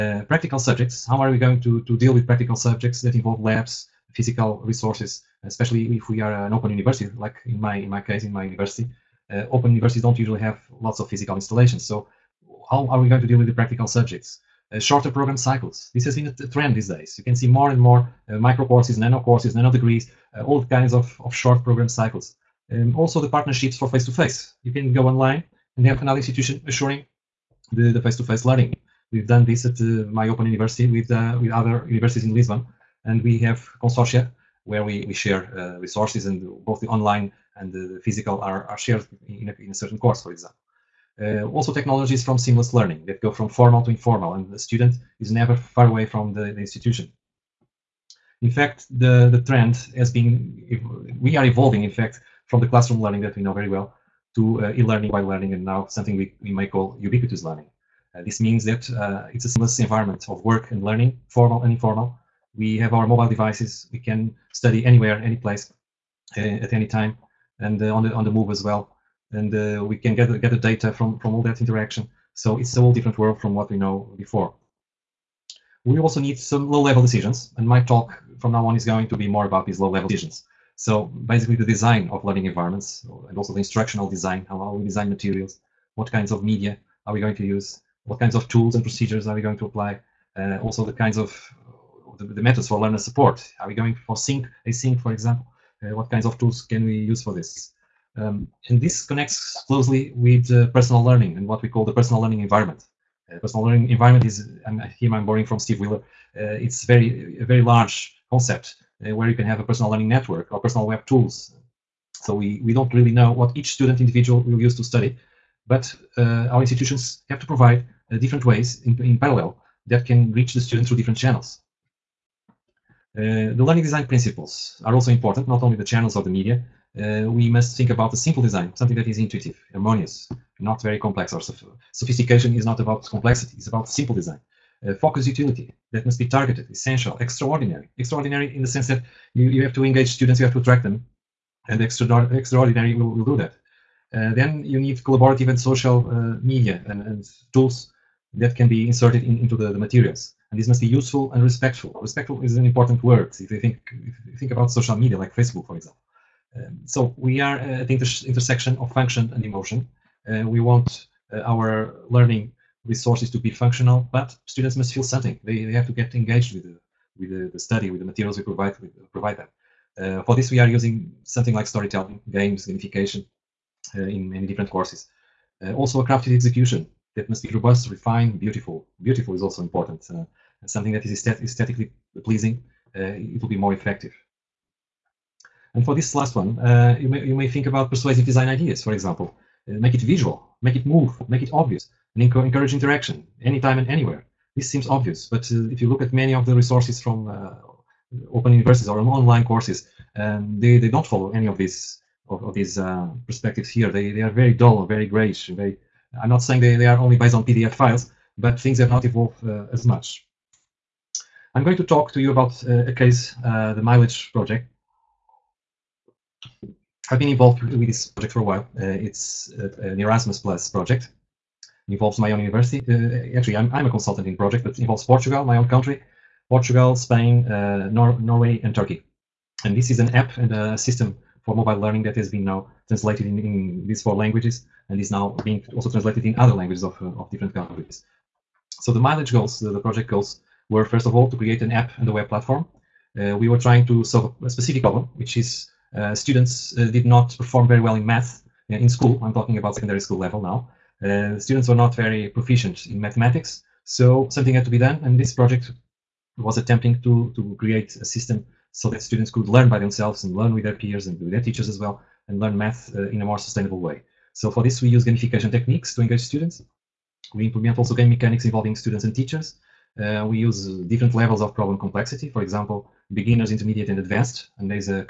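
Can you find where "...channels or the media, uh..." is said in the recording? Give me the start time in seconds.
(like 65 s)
125 s.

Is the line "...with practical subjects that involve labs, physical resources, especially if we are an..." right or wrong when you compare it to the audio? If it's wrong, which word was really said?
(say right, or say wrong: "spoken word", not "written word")
right.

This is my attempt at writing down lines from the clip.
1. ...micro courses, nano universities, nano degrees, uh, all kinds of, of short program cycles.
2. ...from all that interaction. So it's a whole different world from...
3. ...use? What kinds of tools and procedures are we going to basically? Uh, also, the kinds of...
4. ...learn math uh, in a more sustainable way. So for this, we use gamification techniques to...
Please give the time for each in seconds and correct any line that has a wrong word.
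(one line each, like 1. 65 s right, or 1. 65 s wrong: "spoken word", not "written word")
1. 18 s wrong: "courses", not "universities"
2. 71 s right
3. 87 s wrong: "apply", not "basically"
4. 262 s right.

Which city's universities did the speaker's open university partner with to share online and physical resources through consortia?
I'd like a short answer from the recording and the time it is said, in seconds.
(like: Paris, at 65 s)
Lisbon, at 32 s.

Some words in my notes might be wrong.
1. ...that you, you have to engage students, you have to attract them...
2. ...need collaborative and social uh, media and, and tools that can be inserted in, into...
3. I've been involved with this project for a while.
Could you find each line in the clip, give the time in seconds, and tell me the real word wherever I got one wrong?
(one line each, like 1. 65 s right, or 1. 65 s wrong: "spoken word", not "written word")
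1. 138 s right
2. 144 s right
3. 217 s right.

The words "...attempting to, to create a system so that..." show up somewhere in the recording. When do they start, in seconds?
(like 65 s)
256 s.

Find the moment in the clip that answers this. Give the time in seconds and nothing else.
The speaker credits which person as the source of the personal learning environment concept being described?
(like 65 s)
105 s.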